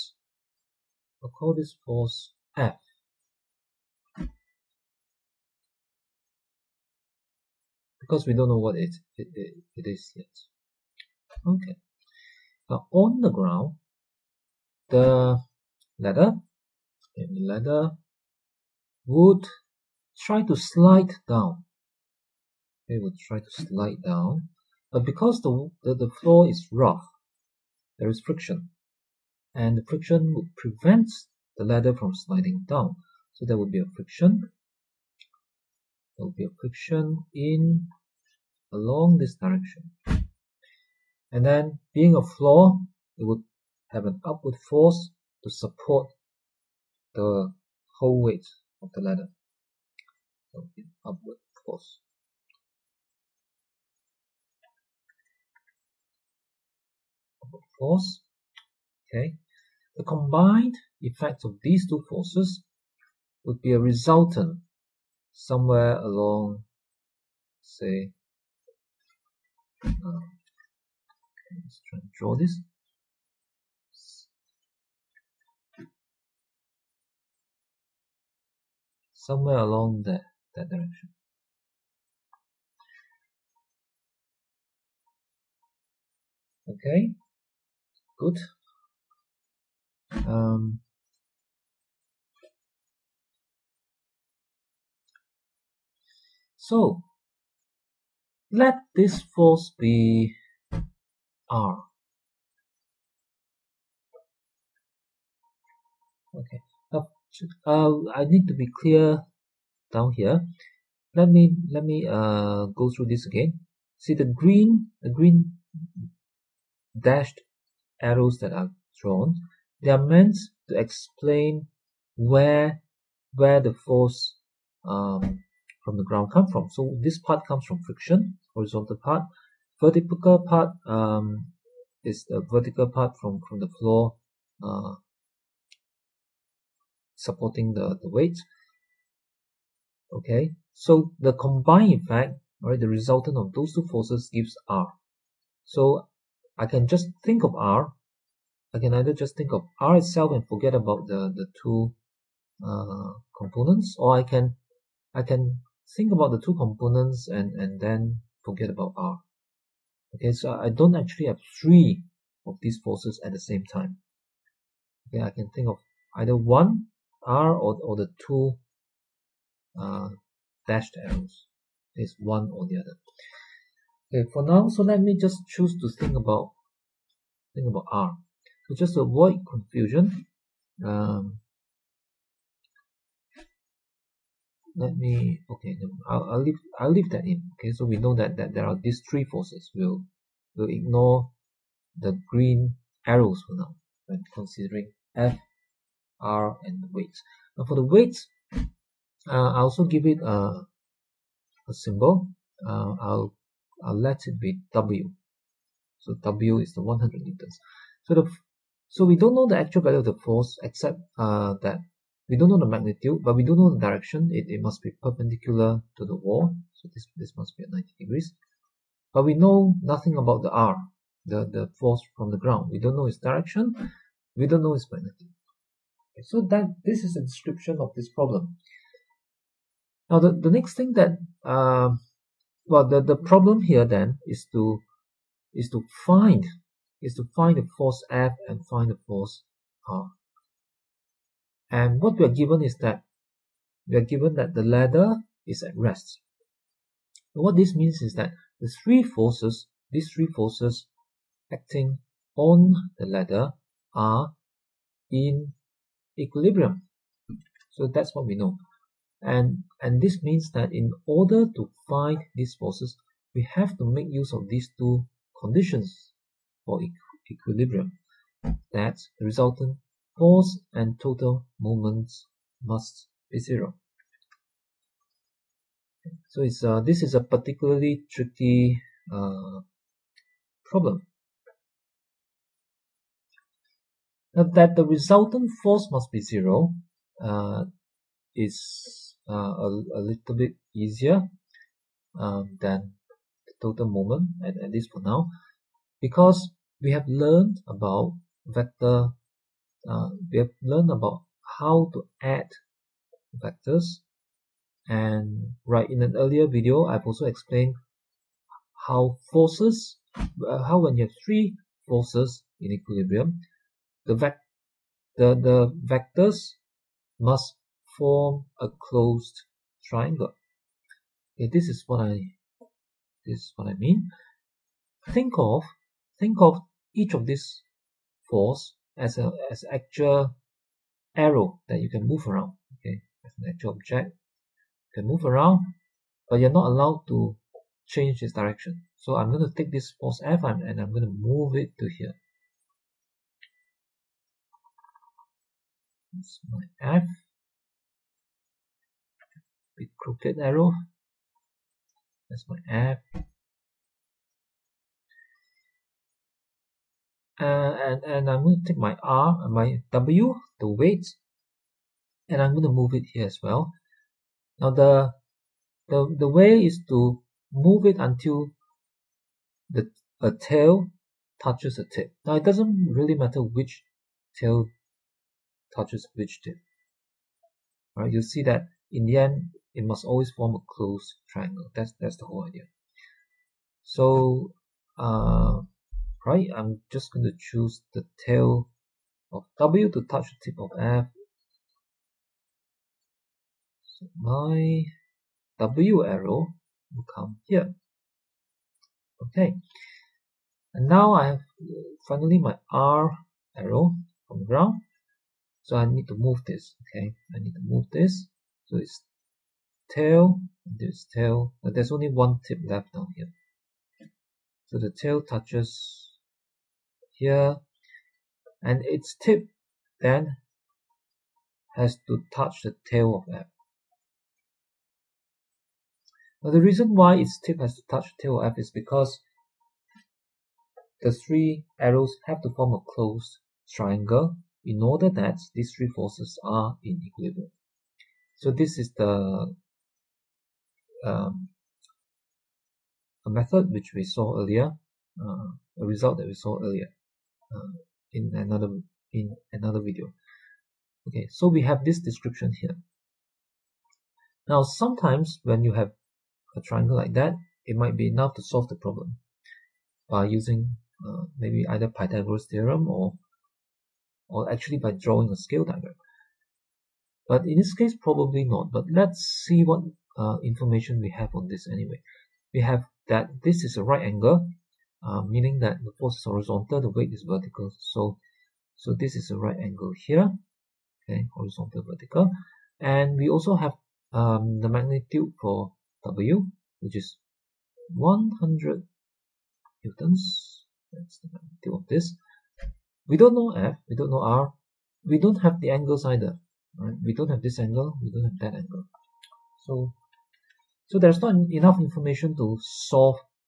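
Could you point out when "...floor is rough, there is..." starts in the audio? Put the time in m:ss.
0:26.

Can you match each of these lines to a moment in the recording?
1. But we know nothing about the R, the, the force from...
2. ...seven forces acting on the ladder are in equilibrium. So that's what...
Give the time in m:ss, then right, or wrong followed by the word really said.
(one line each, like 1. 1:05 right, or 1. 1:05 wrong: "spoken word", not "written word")
1. 3:39 right
2. 4:10 wrong: "three", not "seven".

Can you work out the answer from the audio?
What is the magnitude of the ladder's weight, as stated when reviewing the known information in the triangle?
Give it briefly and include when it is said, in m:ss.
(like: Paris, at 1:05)
100 newtons, at 8:07.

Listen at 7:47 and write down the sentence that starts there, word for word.
But in this case, probably not.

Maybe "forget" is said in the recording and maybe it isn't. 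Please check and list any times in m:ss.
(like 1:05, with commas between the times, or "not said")
2:30, 2:38.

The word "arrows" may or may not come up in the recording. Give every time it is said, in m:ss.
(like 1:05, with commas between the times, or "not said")
1:58, 2:51, 3:13, 5:31, 5:50, 6:36, 6:43, 7:11.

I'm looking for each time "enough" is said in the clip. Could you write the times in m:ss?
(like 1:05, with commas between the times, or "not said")
7:38, 8:21.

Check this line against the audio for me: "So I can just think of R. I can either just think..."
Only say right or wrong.
right.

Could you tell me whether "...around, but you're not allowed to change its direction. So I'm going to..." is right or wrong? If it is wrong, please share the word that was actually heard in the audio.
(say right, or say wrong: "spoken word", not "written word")
right.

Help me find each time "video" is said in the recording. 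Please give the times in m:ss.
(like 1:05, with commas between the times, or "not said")
5:06, 7:29.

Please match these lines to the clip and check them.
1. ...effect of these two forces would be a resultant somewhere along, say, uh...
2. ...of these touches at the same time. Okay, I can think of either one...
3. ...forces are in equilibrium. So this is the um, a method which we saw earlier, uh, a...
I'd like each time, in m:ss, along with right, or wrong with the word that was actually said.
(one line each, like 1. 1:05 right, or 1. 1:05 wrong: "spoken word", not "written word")
1. 1:01 right
2. 2:42 wrong: "forces", not "touches"
3. 7:15 right.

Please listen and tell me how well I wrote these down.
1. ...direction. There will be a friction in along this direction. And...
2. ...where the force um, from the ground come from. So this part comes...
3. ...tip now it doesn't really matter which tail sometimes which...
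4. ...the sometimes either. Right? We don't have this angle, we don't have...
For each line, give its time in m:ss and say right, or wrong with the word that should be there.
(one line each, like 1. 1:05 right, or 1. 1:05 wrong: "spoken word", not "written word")
1. 0:33 wrong: "friction", not "direction"
2. 2:03 right
3. 6:11 wrong: "touches", not "sometimes"
4. 8:15 wrong: "angles", not "sometimes".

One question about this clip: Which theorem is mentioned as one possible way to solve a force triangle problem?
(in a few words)
Pythagoras theorem.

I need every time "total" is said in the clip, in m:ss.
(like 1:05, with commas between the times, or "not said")
4:30, 4:53.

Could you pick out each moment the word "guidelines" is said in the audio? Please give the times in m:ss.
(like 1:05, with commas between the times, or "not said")
not said.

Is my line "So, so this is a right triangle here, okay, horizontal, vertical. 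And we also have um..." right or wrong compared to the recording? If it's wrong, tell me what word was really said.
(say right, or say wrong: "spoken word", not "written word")
wrong: "angle", not "triangle".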